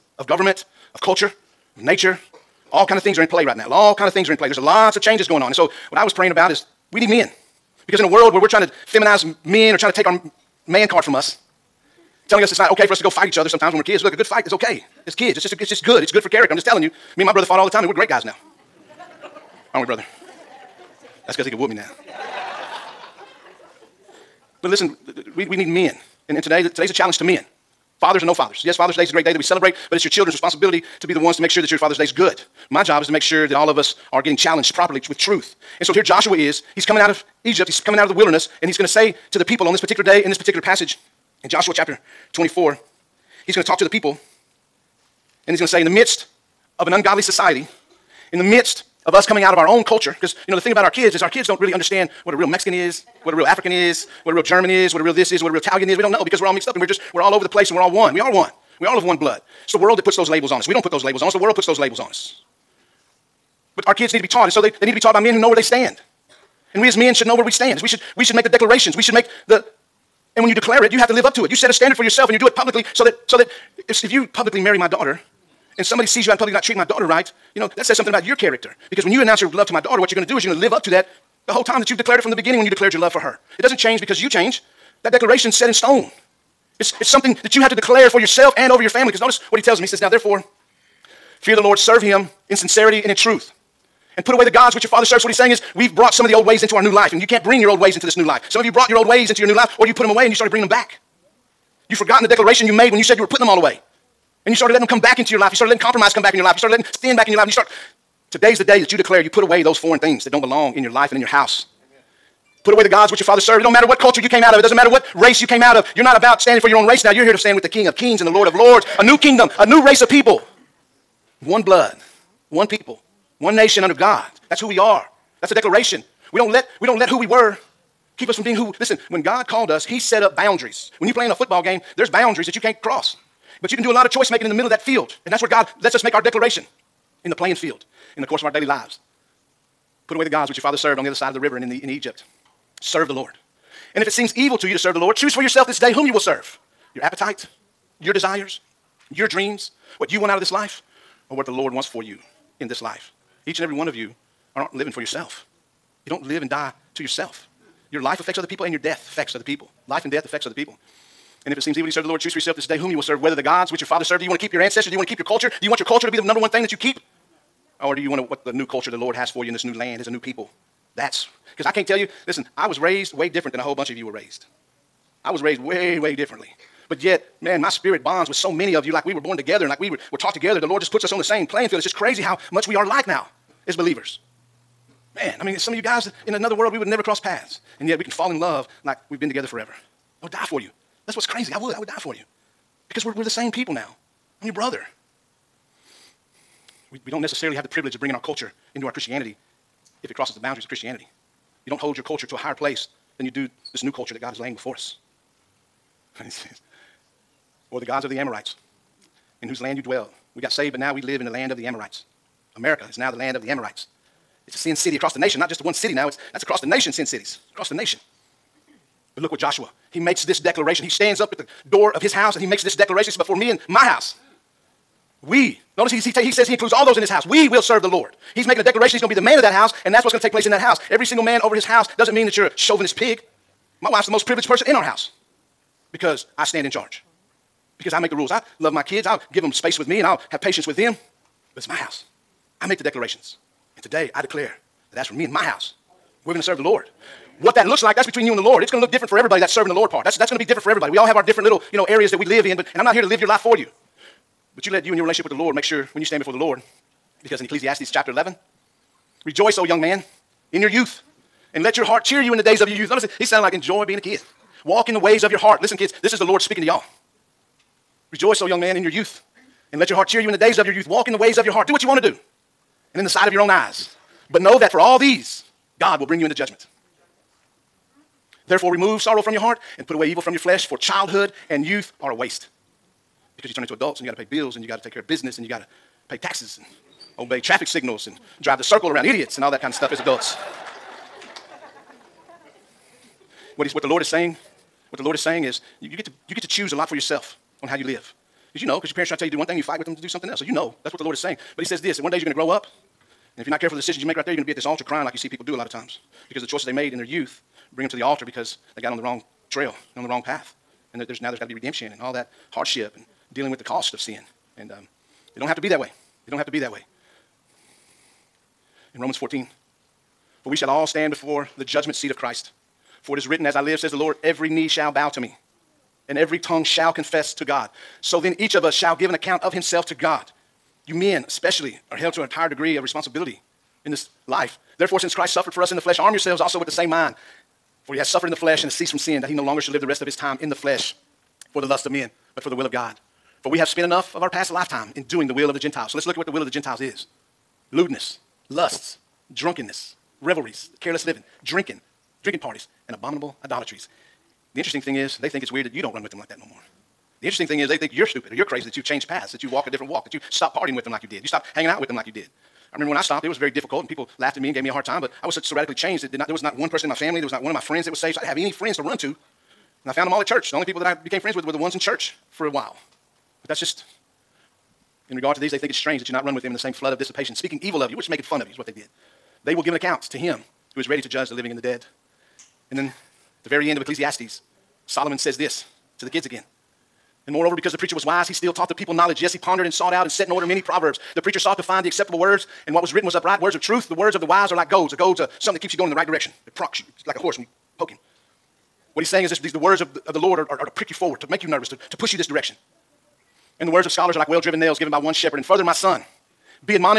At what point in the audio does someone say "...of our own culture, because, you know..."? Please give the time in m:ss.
0:49.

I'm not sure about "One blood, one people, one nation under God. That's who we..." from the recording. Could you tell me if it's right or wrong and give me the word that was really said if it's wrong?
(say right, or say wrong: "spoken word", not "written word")
right.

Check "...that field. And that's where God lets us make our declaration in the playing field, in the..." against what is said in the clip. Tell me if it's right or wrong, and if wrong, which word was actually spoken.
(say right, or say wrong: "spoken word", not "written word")
right.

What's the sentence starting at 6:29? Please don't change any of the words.
Yes, he pondered and sought out and set in order many proverbs.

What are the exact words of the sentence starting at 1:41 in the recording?
You've forgotten the declaration you made when you said you were putting them all away.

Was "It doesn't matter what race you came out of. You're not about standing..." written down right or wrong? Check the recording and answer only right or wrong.
right.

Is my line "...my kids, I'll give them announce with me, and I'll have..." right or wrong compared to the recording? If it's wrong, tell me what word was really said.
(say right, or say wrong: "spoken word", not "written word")
wrong: "space", not "announce".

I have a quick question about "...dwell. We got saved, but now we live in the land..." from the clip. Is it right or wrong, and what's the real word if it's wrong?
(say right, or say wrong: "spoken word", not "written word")
right.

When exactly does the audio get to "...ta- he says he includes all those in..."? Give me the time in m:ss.
3:46.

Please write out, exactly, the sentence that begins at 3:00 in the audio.
The Lord just puts us on the same playing field.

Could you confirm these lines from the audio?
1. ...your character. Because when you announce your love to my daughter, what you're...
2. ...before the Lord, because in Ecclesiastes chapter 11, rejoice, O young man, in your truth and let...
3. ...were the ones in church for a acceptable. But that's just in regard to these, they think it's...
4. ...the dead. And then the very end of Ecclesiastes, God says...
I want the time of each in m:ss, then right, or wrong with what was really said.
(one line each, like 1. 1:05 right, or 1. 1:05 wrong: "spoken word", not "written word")
1. 1:18 right
2. 4:16 wrong: "youth", not "truth"
3. 6:11 wrong: "while", not "acceptable"
4. 6:21 wrong: "Solomon", not "God".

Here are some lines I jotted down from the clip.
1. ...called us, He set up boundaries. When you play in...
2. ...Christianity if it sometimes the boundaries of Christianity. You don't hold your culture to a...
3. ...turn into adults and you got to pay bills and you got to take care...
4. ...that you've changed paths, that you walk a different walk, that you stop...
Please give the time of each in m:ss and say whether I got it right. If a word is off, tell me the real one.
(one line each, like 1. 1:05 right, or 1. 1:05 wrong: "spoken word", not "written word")
1. 2:09 right
2. 3:18 wrong: "crosses", not "sometimes"
3. 4:43 right
4. 5:58 right.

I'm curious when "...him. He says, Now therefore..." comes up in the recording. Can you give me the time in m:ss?
1:29.